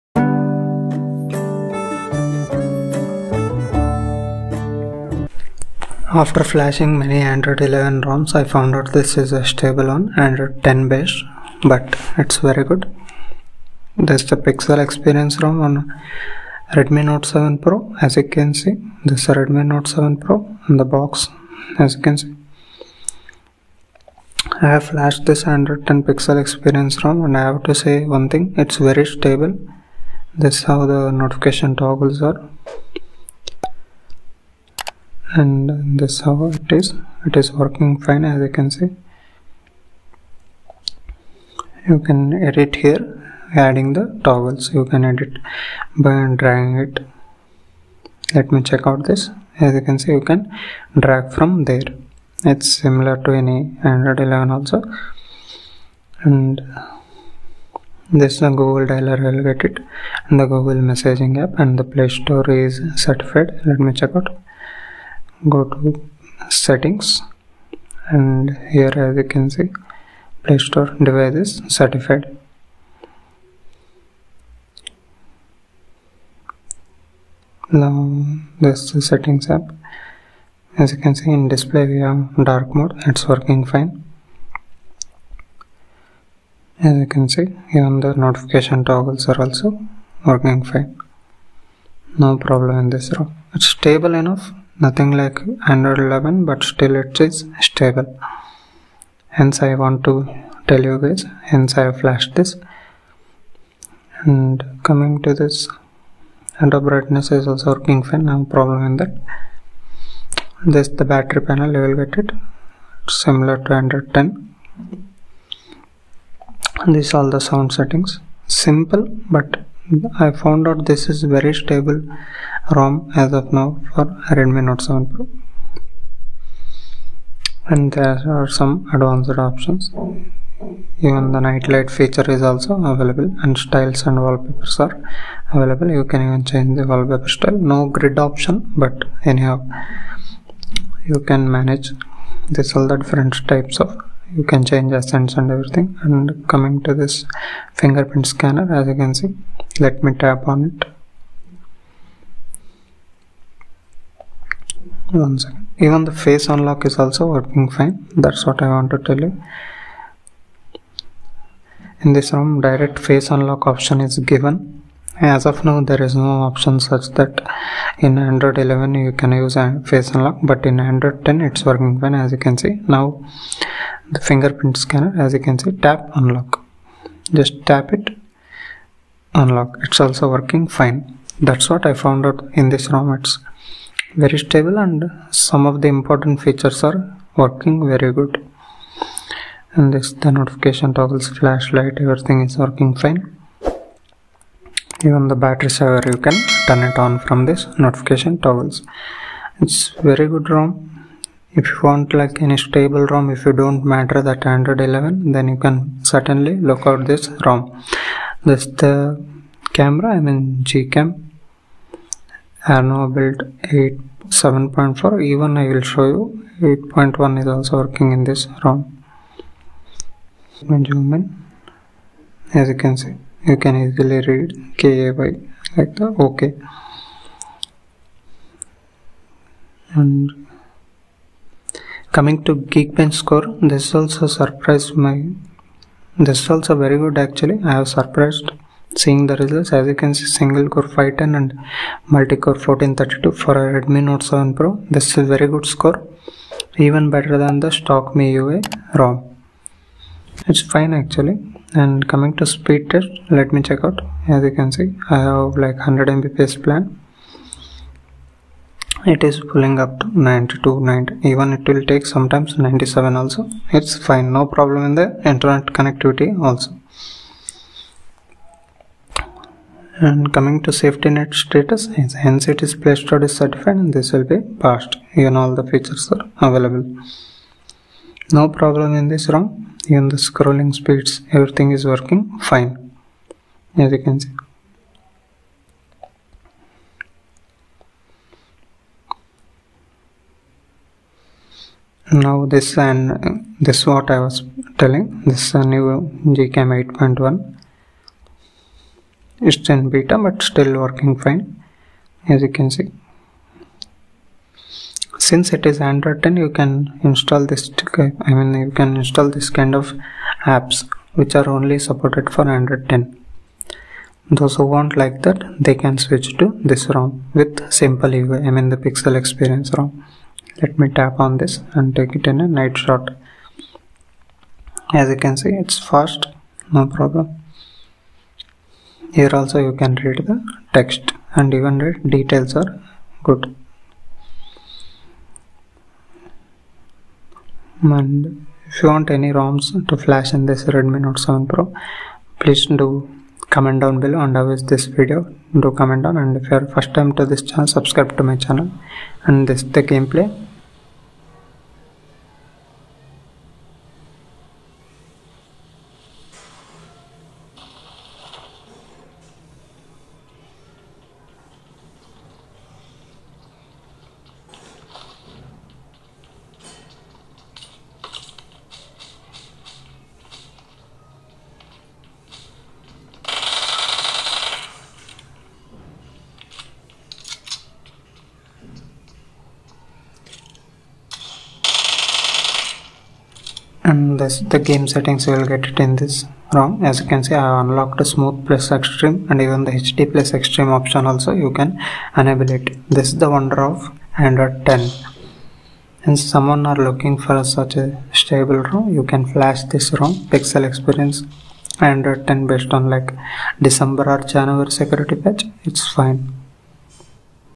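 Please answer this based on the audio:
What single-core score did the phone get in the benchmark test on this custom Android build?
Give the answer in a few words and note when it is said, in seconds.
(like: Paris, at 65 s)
510, at 240 s.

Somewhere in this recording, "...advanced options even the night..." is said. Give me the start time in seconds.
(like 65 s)
128 s.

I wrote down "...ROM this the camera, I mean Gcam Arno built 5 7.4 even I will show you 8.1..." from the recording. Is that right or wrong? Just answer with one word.
wrong.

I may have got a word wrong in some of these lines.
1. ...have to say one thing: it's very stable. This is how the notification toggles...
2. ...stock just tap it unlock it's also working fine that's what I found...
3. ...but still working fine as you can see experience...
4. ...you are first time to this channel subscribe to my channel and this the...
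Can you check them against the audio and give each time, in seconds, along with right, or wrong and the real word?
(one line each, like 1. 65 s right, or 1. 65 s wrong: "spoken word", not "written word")
1. 27 s right
2. 176 s wrong: "unlock", not "stock"
3. 300 s wrong: "since", not "experience"
4. 346 s right.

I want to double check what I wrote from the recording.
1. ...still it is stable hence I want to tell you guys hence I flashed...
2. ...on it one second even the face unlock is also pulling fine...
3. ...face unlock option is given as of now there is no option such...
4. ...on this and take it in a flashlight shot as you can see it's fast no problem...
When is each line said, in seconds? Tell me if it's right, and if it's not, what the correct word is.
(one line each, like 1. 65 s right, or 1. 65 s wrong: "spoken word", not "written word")
1. 96 s right
2. 150 s wrong: "working", not "pulling"
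3. 162 s right
4. 321 s wrong: "night", not "flashlight".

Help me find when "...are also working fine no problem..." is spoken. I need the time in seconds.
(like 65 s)
89 s.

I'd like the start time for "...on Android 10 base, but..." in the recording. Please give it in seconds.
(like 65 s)
9 s.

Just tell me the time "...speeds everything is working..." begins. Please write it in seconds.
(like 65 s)
280 s.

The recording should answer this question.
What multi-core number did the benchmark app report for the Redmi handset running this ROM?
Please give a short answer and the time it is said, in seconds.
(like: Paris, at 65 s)
1432, at 242 s.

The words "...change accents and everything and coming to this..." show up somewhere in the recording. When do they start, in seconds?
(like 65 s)
144 s.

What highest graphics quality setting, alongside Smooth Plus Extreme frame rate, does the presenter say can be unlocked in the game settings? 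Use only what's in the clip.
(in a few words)
HD Plus Extreme.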